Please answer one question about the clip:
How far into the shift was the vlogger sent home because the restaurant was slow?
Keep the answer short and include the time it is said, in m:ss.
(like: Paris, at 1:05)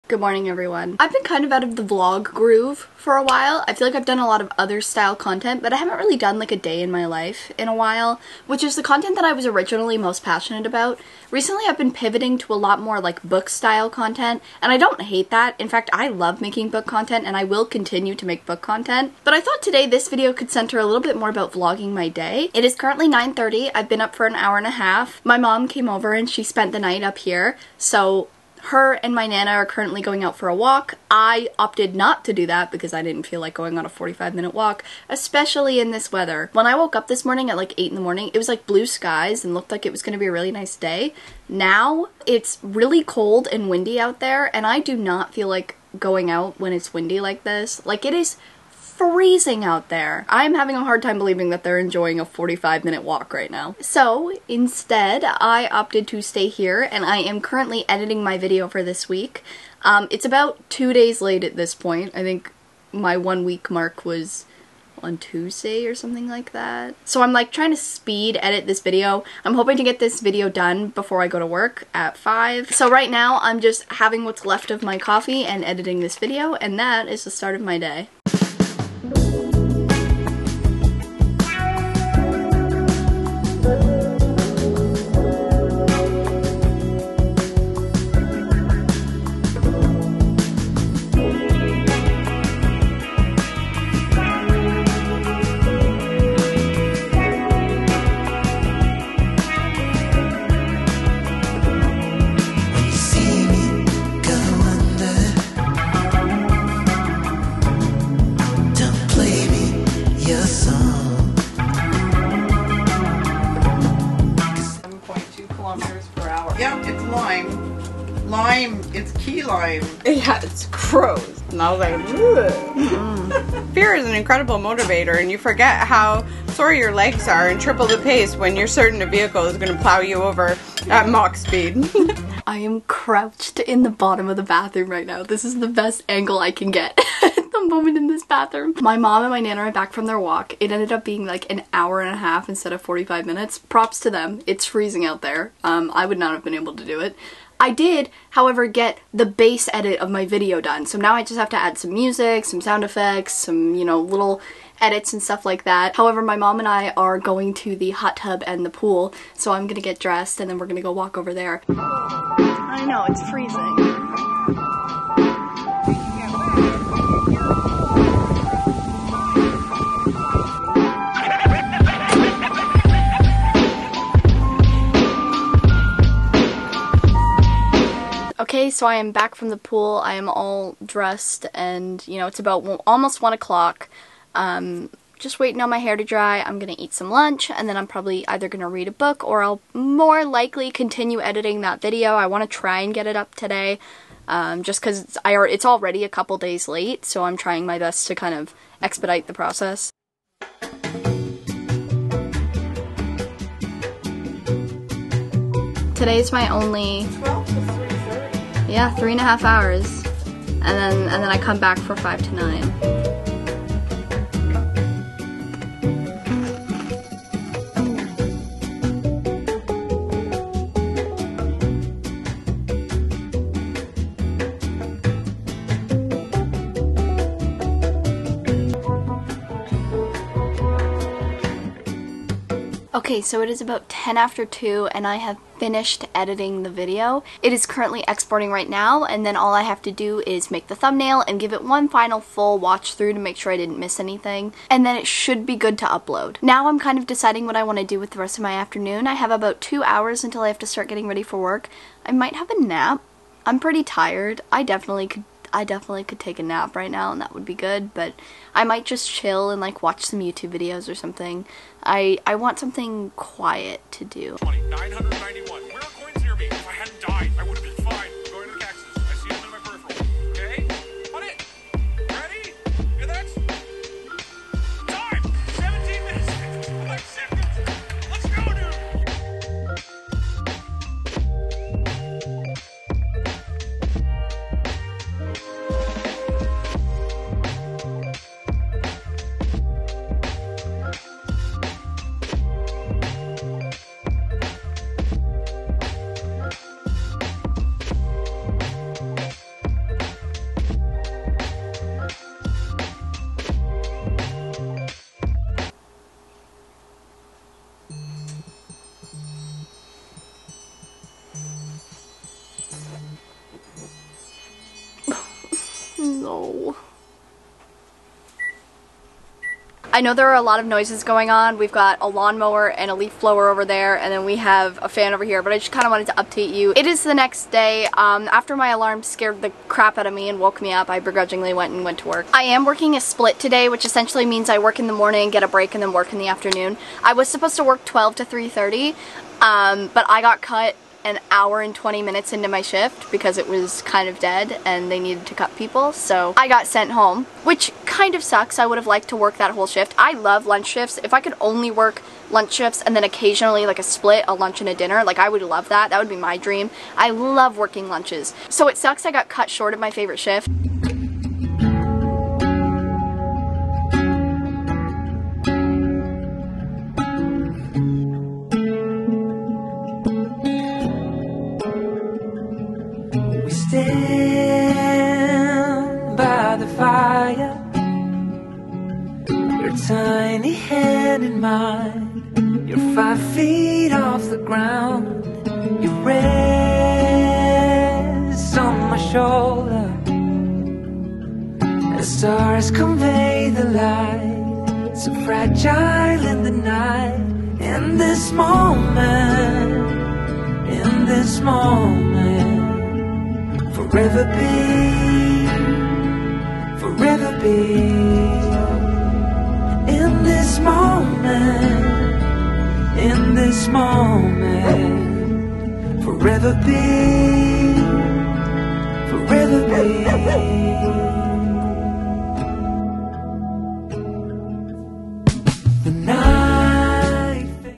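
an hour and 20 minutes, at 5:41.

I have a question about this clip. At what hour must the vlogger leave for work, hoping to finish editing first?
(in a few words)
5.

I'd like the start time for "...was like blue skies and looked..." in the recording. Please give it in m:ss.
0:38.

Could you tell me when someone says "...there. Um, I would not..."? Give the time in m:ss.
2:25.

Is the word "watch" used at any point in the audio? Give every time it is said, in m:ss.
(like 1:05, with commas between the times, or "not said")
4:02, 4:19.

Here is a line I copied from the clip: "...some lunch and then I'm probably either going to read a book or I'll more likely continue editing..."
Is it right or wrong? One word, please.
right.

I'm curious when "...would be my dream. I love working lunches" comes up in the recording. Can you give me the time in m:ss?
5:55.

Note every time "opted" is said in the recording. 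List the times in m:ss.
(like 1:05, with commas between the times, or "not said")
0:31, 0:55.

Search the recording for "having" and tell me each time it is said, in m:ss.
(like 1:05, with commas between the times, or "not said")
0:50, 1:13.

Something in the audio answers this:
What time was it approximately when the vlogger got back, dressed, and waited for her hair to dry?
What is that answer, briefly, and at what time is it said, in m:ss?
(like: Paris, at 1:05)
almost 1 o'clock, at 3:02.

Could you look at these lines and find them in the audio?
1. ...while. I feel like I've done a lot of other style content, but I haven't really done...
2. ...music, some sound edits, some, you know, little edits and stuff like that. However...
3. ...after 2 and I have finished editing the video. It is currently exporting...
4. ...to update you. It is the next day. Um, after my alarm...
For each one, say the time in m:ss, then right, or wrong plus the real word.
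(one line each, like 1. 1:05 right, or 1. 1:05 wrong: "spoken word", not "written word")
1. 0:03 right
2. 2:31 wrong: "effects", not "edits"
3. 3:54 right
4. 5:26 right.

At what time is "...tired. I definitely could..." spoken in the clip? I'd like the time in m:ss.
4:13.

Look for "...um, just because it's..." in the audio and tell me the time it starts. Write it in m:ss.
3:14.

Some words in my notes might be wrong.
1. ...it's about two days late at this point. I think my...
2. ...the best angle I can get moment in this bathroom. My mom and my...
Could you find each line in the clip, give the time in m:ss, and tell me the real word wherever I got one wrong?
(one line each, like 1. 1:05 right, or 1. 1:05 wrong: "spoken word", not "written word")
1. 1:00 right
2. 2:15 right.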